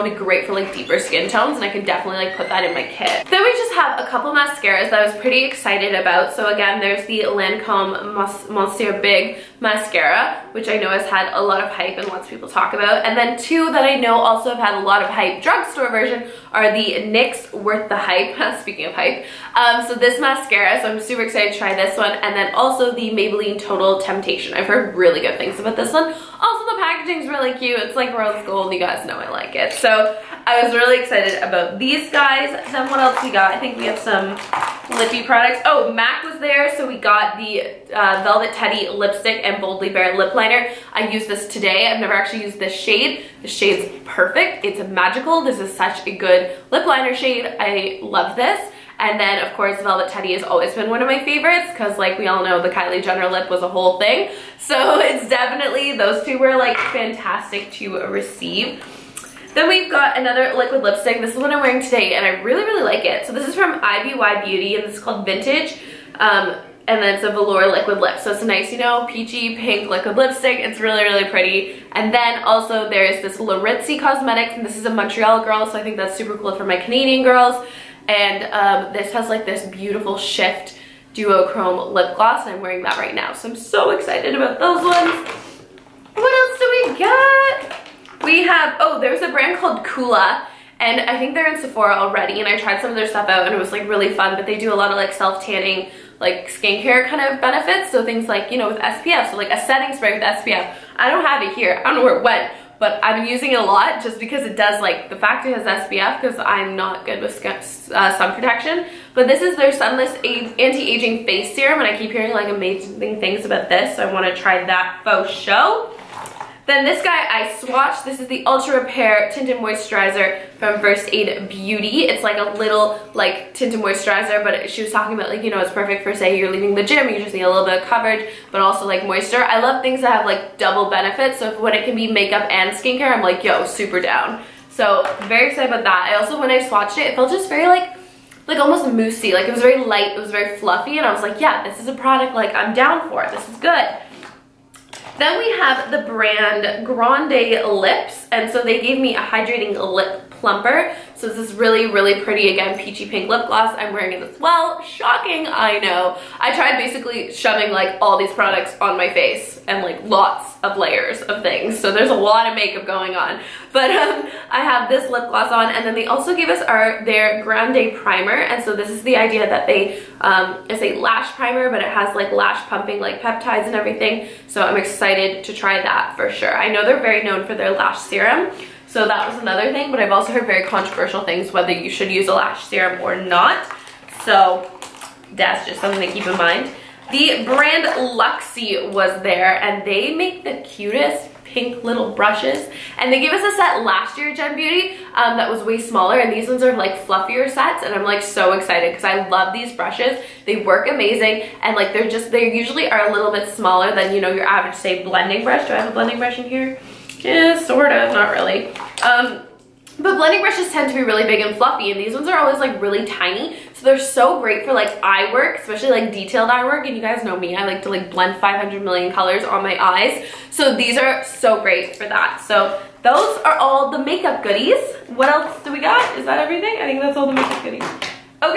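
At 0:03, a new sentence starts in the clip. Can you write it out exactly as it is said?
Then we just have a couple mascaras that I was pretty excited about.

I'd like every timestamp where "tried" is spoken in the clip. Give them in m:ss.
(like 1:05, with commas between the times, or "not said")
1:32, 2:36.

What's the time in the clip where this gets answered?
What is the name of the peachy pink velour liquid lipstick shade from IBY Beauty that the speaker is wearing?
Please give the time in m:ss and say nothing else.
1:05.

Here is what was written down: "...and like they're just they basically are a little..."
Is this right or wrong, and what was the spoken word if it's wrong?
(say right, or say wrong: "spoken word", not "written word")
wrong: "usually", not "basically".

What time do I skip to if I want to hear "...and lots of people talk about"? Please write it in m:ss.
0:11.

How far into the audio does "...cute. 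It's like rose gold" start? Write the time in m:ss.
0:27.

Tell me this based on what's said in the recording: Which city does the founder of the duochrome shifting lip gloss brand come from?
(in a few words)
Montreal.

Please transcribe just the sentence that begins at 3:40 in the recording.
So these are so great for that.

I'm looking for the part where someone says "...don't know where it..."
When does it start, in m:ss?
1:41.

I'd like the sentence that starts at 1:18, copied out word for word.
And um, this has like this beautiful shift duochrome lip gloss and I'm wearing that right now.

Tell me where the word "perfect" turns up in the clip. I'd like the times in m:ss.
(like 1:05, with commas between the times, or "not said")
0:44, 2:05.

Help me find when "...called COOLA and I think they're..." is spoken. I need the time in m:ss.
1:29.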